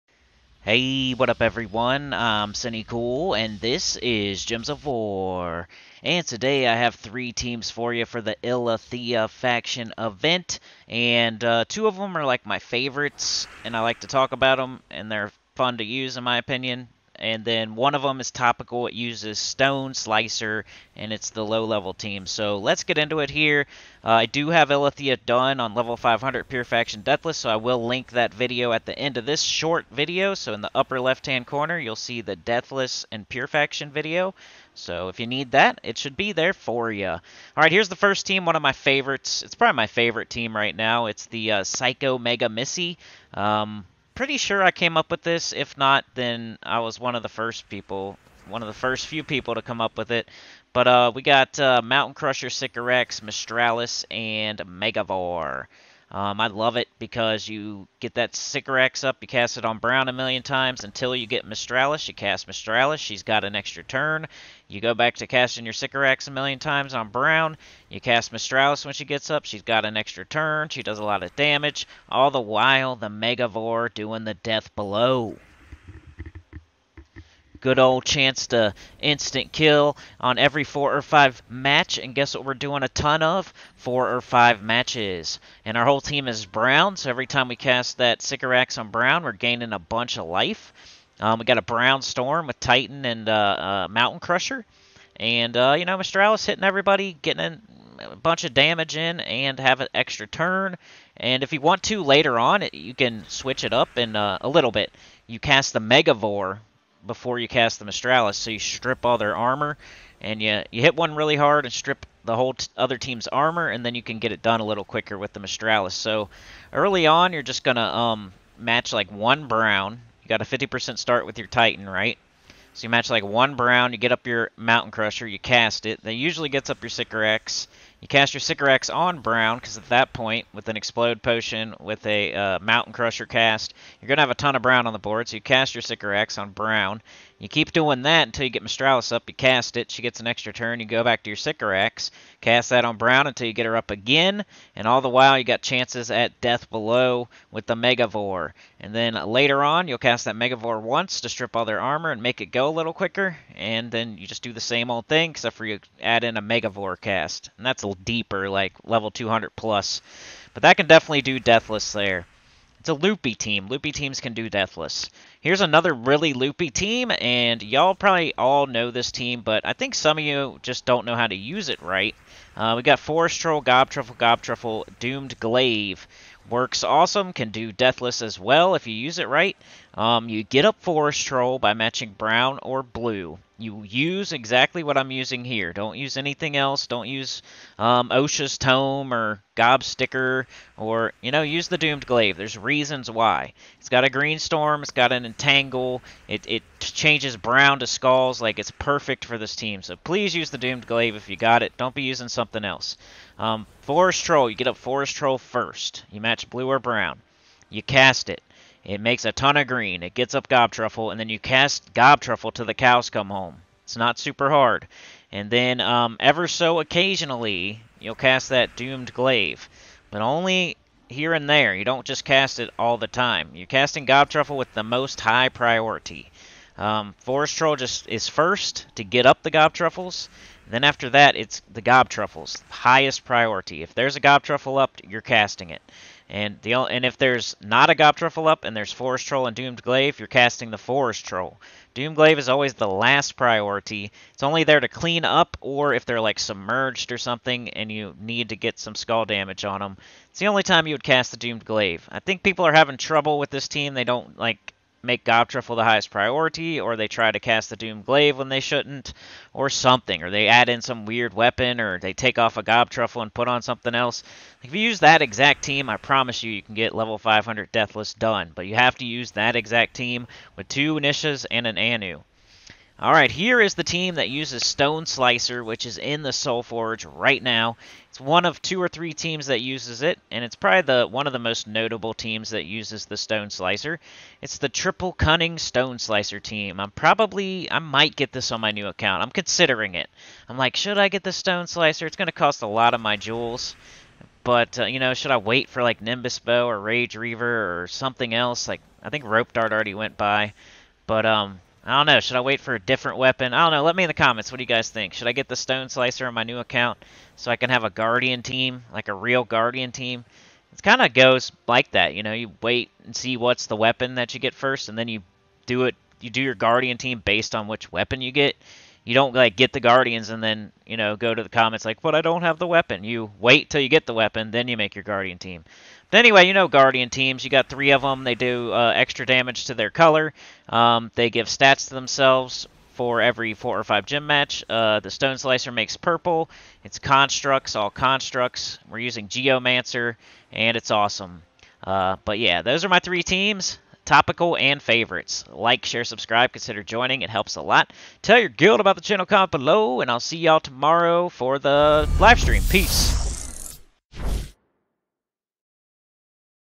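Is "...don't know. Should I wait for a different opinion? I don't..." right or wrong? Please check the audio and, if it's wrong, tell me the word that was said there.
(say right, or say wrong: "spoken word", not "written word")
wrong: "weapon", not "opinion".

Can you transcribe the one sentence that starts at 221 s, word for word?
You don't just cast it all the time.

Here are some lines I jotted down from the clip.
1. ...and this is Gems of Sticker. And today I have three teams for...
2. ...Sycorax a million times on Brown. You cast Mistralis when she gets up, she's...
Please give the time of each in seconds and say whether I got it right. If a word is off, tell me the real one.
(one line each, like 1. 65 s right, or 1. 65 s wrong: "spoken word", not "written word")
1. 3 s wrong: "War", not "Sticker"
2. 65 s right.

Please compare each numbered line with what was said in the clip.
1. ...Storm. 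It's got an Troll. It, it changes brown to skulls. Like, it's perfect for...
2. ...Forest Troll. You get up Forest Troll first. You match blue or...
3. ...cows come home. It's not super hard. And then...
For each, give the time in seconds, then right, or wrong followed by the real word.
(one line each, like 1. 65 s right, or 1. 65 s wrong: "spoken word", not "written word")
1. 194 s wrong: "Entangle", not "Troll"
2. 203 s right
3. 212 s right.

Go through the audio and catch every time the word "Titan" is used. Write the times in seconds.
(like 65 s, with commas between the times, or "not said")
92 s, 121 s.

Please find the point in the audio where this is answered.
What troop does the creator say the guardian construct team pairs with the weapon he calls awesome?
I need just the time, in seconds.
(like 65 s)
339 s.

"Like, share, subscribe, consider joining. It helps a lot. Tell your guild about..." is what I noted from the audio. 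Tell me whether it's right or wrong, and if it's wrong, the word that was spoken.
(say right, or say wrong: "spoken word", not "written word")
right.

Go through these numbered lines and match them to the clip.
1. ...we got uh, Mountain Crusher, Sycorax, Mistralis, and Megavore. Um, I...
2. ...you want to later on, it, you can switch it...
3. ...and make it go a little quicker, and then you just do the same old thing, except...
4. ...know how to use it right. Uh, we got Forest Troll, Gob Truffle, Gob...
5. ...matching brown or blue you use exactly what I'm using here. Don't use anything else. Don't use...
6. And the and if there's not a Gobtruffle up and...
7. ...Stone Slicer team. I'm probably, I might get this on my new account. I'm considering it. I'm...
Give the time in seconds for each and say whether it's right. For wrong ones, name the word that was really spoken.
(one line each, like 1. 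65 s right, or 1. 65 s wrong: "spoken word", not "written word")
1. 51 s right
2. 101 s right
3. 152 s right
4. 171 s right
5. 181 s right
6. 236 s right
7. 285 s right.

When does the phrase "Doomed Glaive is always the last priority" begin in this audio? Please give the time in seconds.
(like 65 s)
241 s.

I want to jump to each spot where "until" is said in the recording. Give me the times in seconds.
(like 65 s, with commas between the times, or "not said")
60 s, 138 s, 143 s.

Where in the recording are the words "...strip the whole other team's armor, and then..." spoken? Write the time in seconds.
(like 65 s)
111 s.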